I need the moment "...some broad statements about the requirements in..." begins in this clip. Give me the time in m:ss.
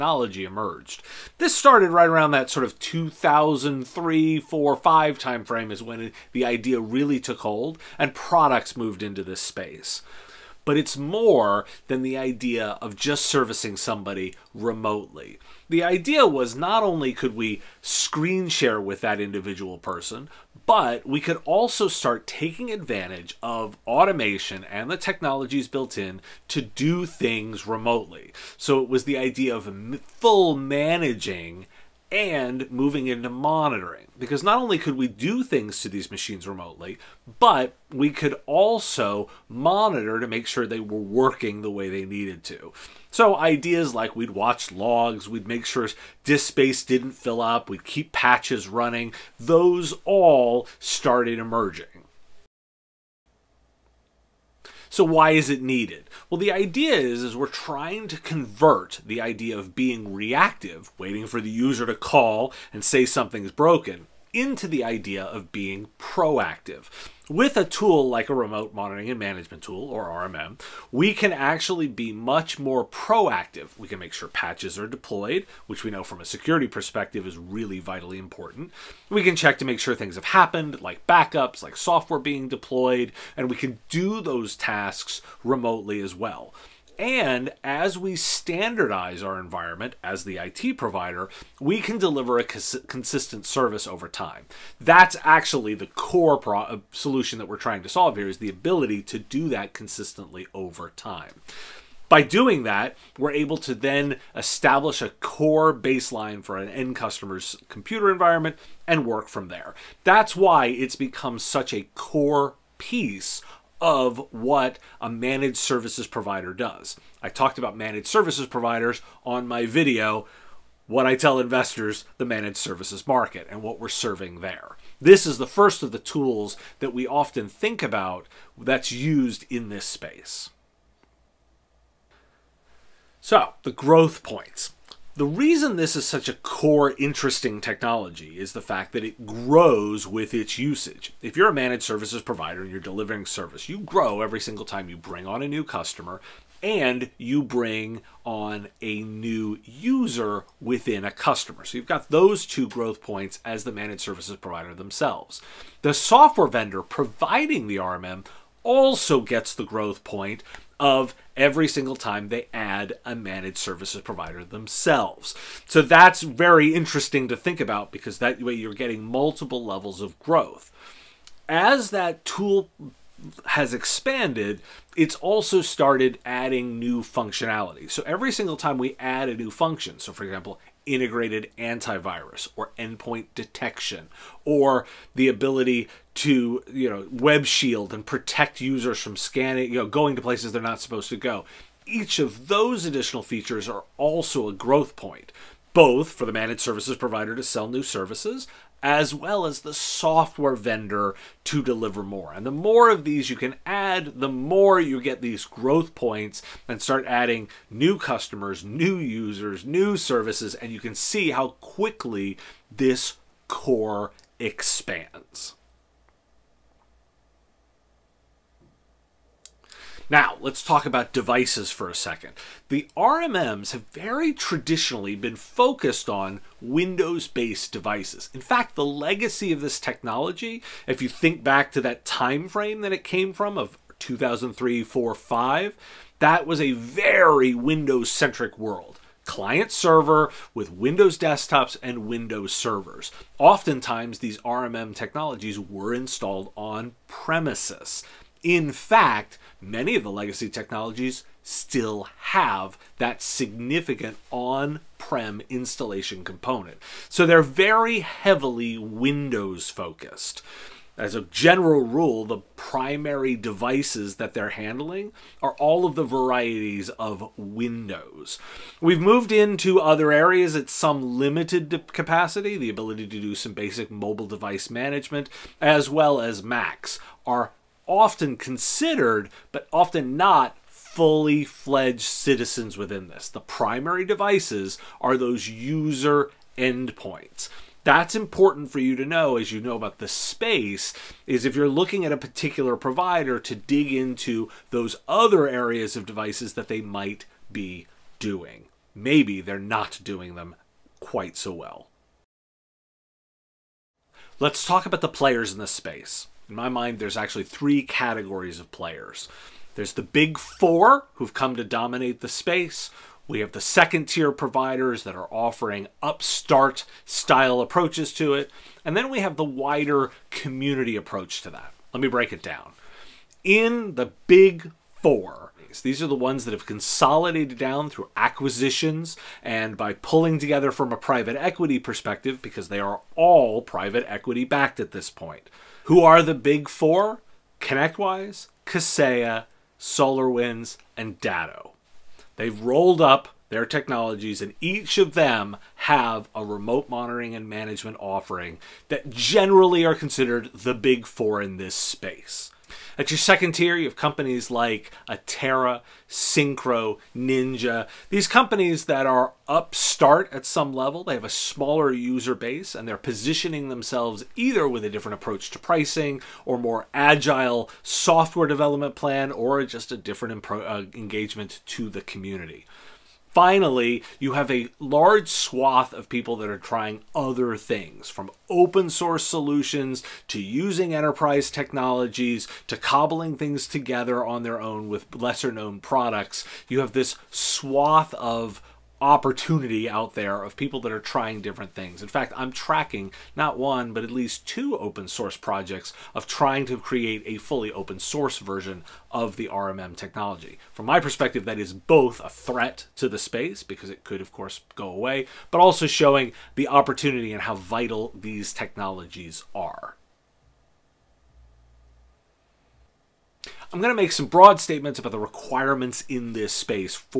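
6:54.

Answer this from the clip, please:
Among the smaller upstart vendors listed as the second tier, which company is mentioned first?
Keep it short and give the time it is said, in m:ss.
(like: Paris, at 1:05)
Atera, at 5:55.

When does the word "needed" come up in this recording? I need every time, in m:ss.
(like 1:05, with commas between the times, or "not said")
0:42, 0:55.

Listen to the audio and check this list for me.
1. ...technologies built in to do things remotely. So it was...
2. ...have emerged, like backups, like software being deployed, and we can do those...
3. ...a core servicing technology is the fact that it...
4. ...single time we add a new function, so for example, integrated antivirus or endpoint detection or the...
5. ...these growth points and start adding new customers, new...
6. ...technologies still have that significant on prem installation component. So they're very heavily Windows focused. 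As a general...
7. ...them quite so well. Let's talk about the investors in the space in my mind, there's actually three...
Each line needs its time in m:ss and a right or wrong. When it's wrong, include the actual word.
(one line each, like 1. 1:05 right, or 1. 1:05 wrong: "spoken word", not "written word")
1. 0:24 right
2. 1:20 wrong: "happened", not "emerged"
3. 2:16 wrong: "interesting", not "servicing"
4. 2:58 right
5. 3:25 right
6. 4:10 right
7. 5:00 wrong: "players", not "investors".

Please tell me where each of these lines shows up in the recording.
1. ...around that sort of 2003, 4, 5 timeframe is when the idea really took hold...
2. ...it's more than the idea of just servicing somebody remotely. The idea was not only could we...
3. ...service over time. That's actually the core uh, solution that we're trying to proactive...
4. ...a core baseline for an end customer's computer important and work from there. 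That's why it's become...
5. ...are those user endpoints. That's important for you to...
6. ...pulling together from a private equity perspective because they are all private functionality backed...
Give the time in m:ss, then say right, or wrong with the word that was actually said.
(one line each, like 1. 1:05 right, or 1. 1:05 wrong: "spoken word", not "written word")
1. 0:02 right
2. 0:10 right
3. 1:33 wrong: "solve", not "proactive"
4. 1:45 wrong: "environment", not "important"
5. 4:45 right
6. 5:29 wrong: "equity", not "functionality".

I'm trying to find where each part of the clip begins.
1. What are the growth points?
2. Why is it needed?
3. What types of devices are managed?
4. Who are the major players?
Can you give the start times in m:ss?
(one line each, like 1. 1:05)
1. 2:11
2. 0:52
3. 3:37
4. 5:02.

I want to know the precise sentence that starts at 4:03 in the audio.
Oftentimes, these RMM technologies were installed on premises.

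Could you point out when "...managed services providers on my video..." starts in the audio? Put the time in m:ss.
1:57.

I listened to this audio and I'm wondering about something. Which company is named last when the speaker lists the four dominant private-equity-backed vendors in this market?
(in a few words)
Datto.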